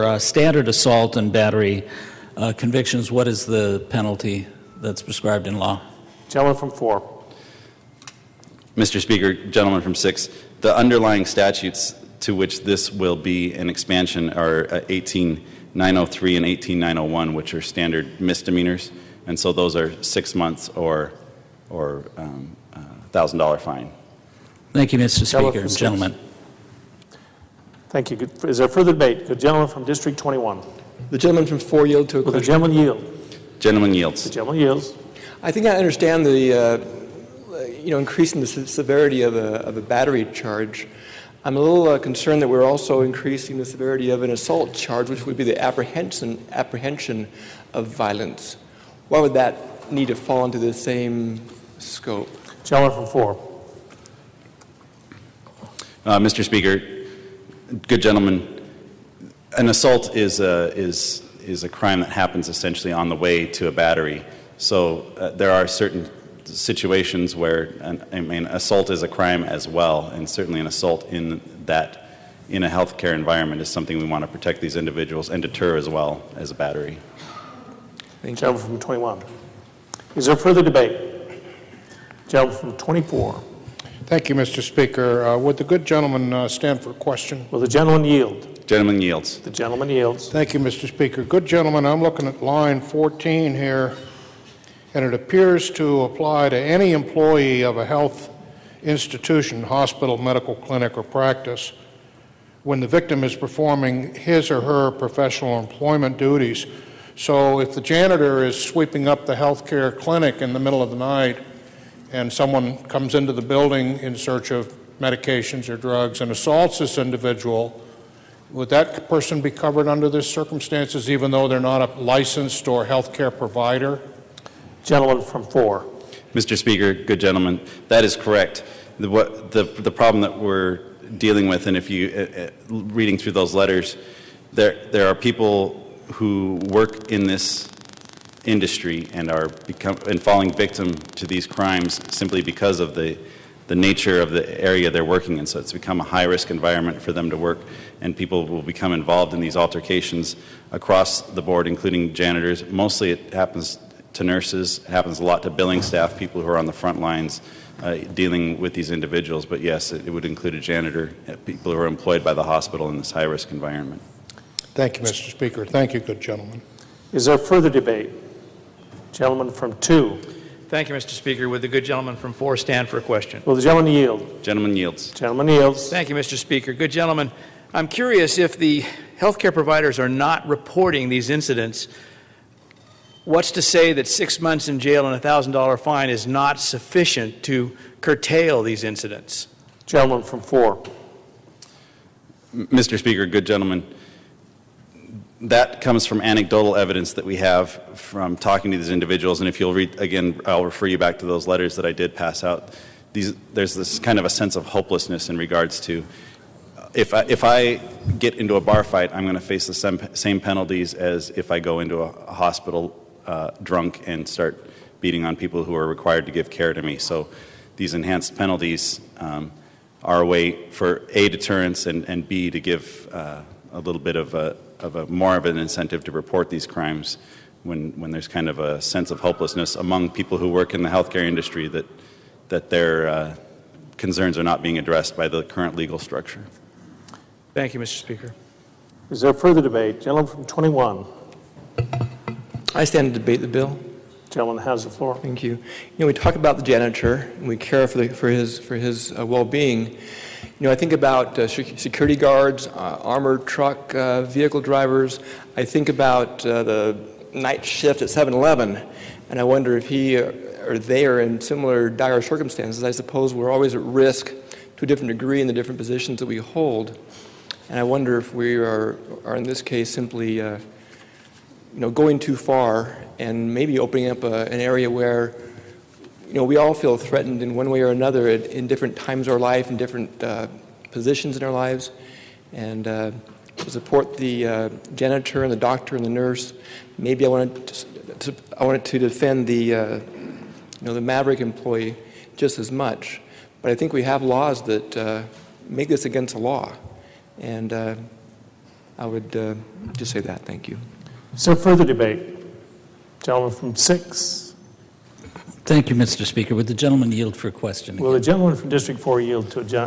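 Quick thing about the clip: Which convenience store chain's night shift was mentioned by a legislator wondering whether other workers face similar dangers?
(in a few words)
7 Eleven.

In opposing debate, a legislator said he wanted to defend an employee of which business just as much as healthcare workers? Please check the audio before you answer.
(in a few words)
Maverik.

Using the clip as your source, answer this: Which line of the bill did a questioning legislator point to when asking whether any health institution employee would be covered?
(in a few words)
Line 14.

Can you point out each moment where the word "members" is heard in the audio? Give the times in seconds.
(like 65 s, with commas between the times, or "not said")
not said.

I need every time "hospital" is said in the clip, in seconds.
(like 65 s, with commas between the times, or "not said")
99 s, 162 s, 212 s.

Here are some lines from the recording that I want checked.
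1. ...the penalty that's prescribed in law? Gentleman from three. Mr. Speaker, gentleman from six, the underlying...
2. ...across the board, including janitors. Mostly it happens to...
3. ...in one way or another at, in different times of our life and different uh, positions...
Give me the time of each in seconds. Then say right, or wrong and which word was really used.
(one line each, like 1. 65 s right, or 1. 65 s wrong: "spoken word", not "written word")
1. 3 s wrong: "four", not "three"
2. 150 s right
3. 277 s right.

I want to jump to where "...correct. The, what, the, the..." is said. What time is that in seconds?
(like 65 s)
128 s.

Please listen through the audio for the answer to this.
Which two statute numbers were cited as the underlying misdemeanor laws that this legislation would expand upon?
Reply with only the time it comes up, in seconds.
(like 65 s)
14 s.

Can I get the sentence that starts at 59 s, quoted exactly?
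An assault is a, is, is a crime that happens essentially on the way to a battery.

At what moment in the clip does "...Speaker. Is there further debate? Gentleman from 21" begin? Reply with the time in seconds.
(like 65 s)
237 s.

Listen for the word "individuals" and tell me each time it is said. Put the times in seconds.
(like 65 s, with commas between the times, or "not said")
74 s, 116 s, 158 s, 198 s.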